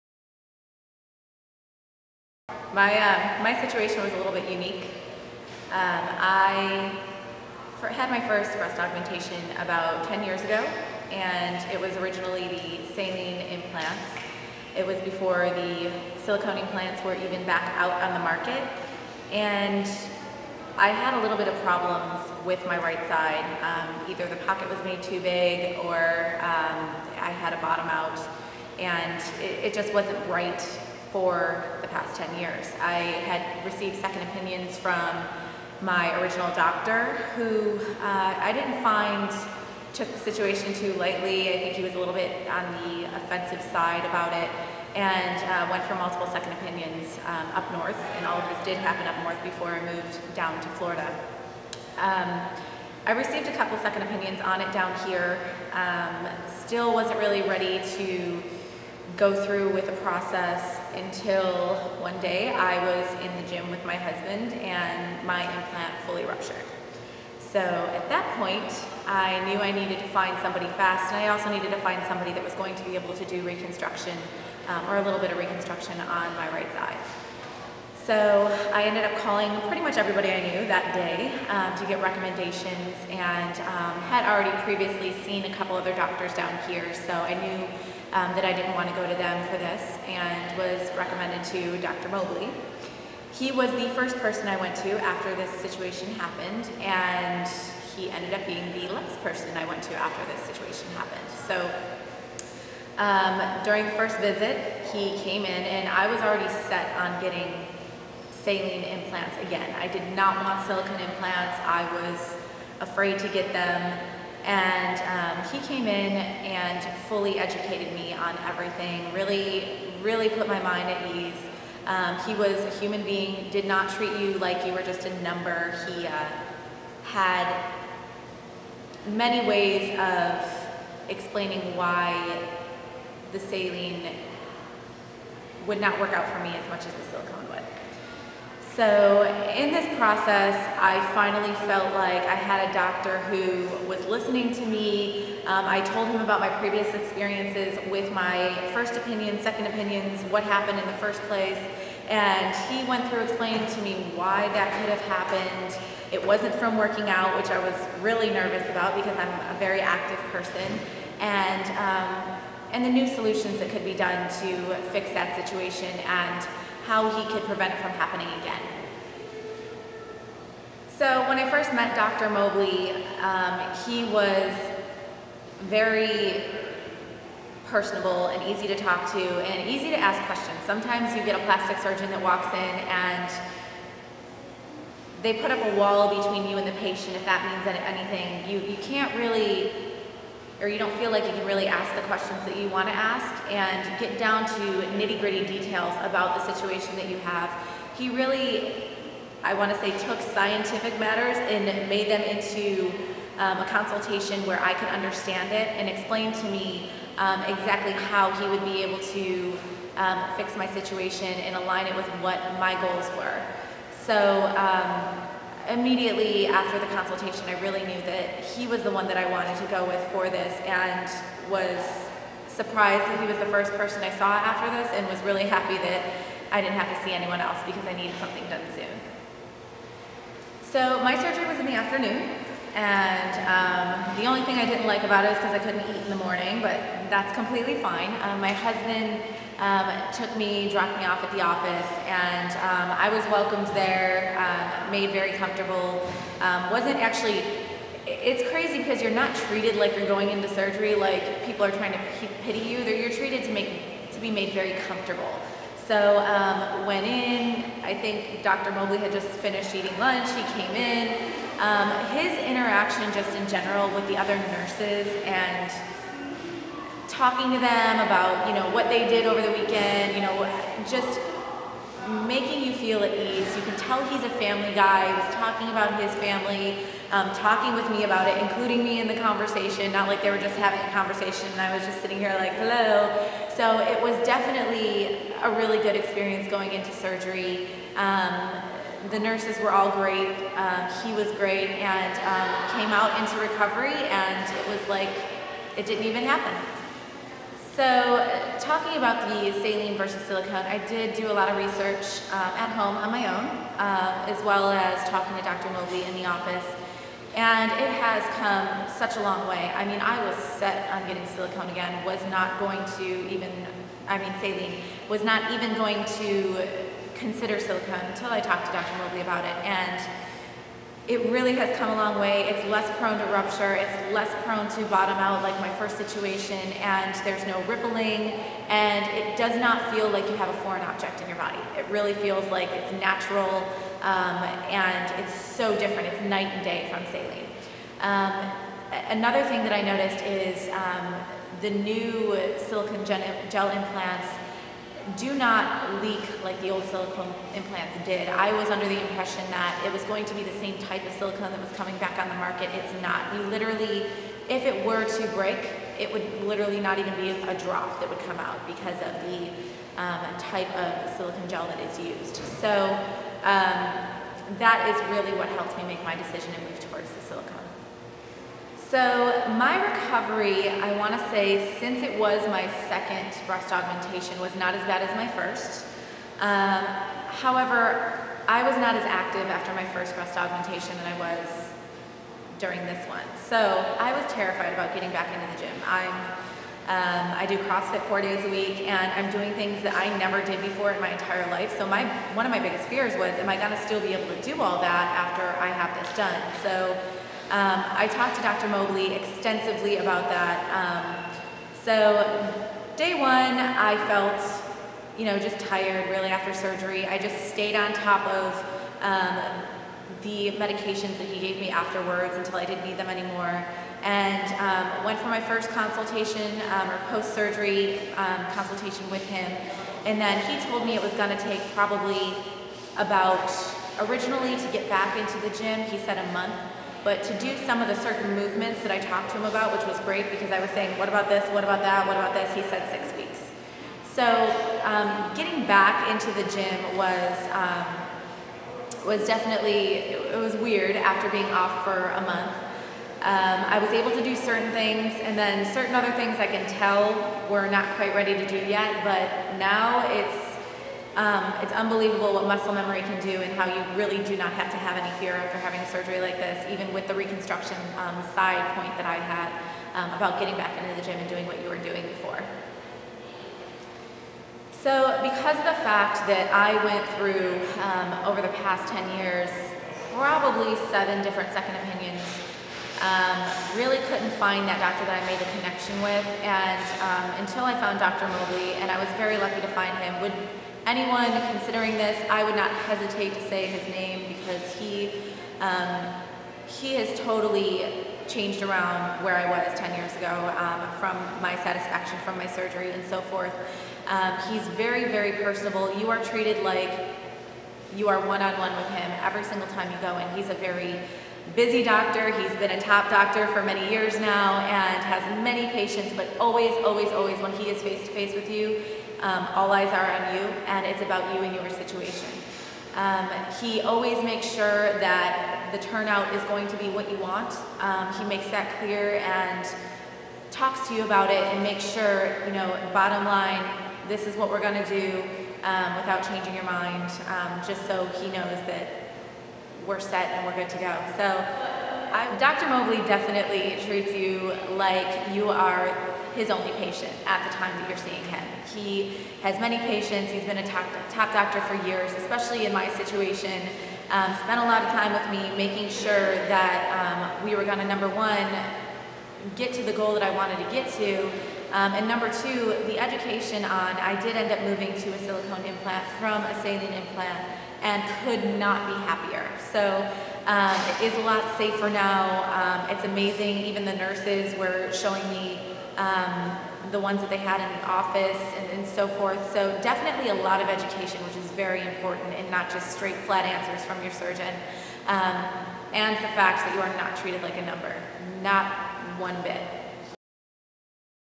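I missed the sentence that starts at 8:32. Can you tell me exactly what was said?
Um, he always makes sure that the turnout is going to be what you want.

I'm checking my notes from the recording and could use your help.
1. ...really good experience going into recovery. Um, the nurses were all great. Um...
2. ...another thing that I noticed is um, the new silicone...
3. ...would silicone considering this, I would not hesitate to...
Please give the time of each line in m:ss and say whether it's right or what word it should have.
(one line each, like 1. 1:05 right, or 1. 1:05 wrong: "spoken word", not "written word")
1. 4:45 wrong: "surgery", not "recovery"
2. 5:39 right
3. 8:00 wrong: "anyone", not "silicone".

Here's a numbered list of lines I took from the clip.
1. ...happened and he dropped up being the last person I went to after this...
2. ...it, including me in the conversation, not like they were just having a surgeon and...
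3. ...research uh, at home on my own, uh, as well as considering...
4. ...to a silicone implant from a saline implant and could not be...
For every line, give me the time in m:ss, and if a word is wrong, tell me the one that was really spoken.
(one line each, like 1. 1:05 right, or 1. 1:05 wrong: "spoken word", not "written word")
1. 1:36 wrong: "ended", not "dropped"
2. 4:38 wrong: "conversation", not "surgeon"
3. 5:01 wrong: "talking", not "considering"
4. 9:15 right.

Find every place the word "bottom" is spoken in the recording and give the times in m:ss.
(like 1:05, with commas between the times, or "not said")
0:27, 5:24, 8:42.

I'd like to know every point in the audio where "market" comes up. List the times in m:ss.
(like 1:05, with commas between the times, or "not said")
0:18, 5:52.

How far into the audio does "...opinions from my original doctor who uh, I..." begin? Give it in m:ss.
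0:34.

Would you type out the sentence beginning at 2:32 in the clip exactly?
And he went through explaining to me why that could have happened.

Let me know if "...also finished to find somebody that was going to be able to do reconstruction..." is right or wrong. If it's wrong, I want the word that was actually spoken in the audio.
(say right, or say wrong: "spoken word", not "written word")
wrong: "needed", not "finished".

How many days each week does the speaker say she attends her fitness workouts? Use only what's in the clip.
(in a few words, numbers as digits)
4.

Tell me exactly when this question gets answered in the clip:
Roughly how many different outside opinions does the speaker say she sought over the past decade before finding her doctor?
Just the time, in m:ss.
7:50.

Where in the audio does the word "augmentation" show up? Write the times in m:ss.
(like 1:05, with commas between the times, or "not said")
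0:08, 6:13, 6:20.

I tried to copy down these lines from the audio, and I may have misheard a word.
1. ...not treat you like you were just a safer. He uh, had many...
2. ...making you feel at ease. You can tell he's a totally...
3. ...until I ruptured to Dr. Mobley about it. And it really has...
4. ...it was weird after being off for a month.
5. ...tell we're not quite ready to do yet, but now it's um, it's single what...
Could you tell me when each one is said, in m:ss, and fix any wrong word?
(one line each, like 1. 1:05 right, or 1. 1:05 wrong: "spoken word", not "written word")
1. 2:03 wrong: "number", not "safer"
2. 4:32 wrong: "family", not "totally"
3. 5:18 wrong: "talked", not "ruptured"
4. 7:20 right
5. 7:26 wrong: "unbelievable", not "single".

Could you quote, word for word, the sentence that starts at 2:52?
Mobley, um, he was very personable and easy to talk to and easy to ask questions.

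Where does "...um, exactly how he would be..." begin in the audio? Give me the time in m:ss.
3:27.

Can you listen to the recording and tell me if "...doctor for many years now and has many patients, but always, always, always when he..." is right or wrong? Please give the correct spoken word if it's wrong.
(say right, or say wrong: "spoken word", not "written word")
right.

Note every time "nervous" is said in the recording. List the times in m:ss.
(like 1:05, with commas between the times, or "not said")
2:38.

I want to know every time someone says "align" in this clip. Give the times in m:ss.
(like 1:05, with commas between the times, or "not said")
3:31.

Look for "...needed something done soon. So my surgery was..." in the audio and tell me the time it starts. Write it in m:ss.
3:47.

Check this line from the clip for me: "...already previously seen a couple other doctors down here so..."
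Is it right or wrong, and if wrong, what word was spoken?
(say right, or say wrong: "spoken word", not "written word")
right.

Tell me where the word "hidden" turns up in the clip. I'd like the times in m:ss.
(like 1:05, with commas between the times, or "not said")
not said.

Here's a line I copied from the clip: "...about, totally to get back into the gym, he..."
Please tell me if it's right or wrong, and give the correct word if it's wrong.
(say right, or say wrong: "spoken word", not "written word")
wrong: "originally", not "totally".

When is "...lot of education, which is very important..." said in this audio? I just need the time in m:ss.
9:30.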